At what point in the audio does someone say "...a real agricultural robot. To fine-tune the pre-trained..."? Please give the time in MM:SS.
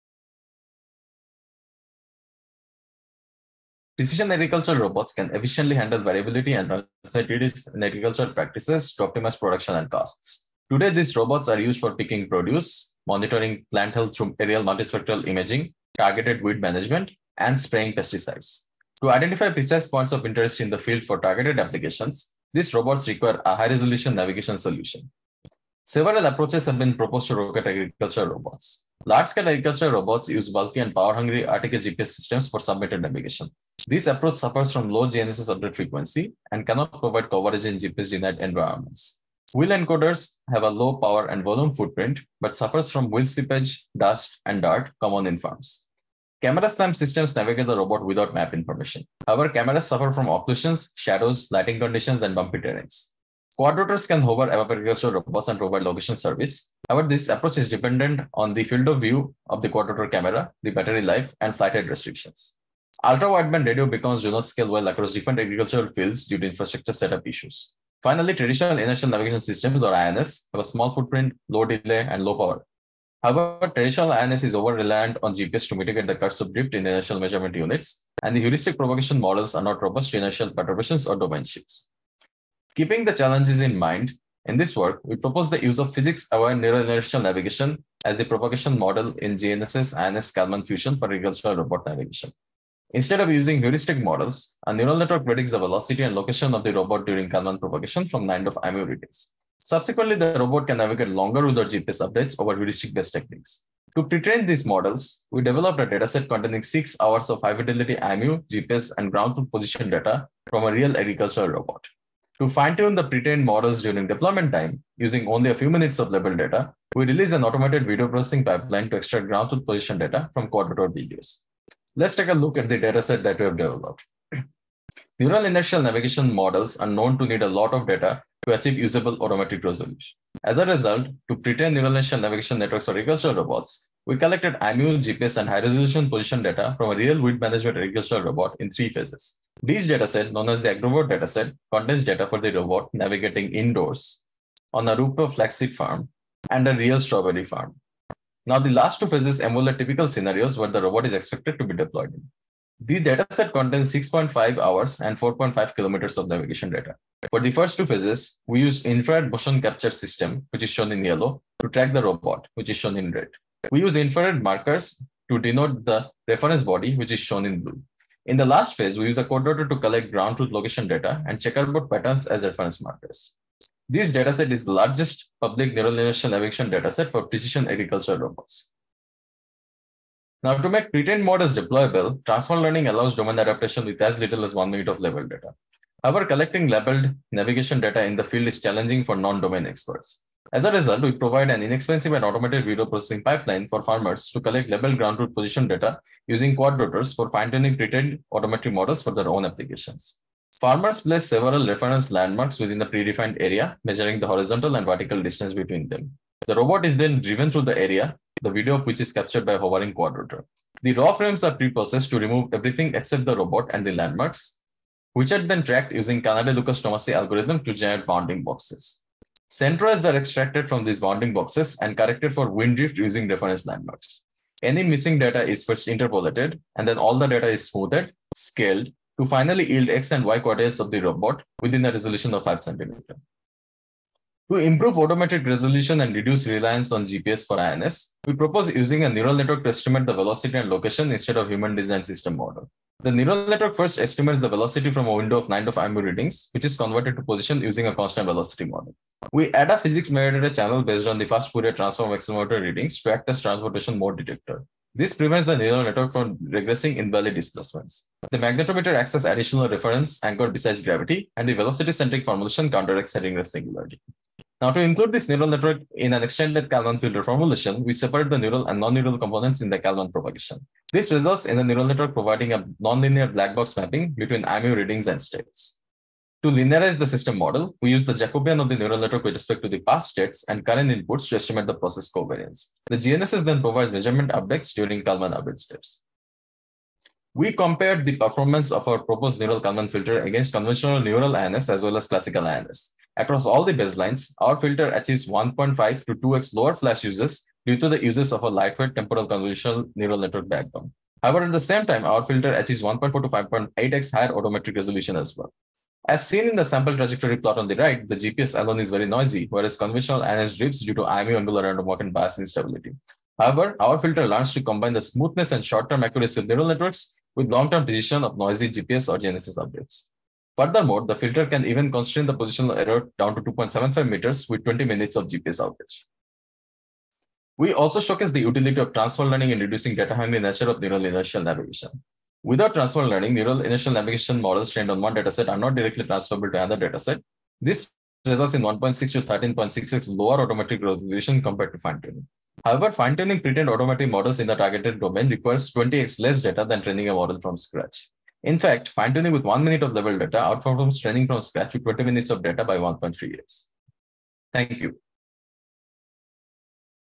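01:50.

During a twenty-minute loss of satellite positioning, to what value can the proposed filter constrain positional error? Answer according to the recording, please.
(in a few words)
2.75 meters.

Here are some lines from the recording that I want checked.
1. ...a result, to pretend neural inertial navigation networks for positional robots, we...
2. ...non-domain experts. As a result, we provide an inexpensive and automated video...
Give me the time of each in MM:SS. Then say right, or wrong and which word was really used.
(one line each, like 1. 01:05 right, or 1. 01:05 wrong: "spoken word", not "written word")
1. 02:10 wrong: "agricultural", not "positional"
2. 03:09 right.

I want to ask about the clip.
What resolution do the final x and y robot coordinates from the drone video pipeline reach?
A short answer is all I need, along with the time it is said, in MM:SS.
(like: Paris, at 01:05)
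5 cm, at 03:52.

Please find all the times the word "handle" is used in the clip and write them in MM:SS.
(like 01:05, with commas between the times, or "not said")
00:05.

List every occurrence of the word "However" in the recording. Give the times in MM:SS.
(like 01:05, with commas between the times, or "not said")
00:49, 00:56, 01:13, 03:06, 05:01, 05:13, 05:42.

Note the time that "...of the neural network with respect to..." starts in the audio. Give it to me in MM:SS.
04:38.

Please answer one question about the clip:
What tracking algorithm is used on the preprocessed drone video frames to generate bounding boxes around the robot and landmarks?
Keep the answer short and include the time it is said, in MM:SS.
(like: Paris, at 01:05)
Kanade-Lucas-Tomasi, at 03:36.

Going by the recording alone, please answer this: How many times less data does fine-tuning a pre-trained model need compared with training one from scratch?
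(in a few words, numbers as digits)
20x.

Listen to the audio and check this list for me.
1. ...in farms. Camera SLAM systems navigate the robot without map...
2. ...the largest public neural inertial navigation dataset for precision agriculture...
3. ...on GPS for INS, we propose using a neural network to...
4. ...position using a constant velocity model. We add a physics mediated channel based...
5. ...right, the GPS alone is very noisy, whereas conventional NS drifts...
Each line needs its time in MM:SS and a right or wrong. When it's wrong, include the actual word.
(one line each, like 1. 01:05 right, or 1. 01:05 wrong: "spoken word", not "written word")
1. 00:45 right
2. 02:54 right
3. 03:56 right
4. 04:07 right
5. 05:07 right.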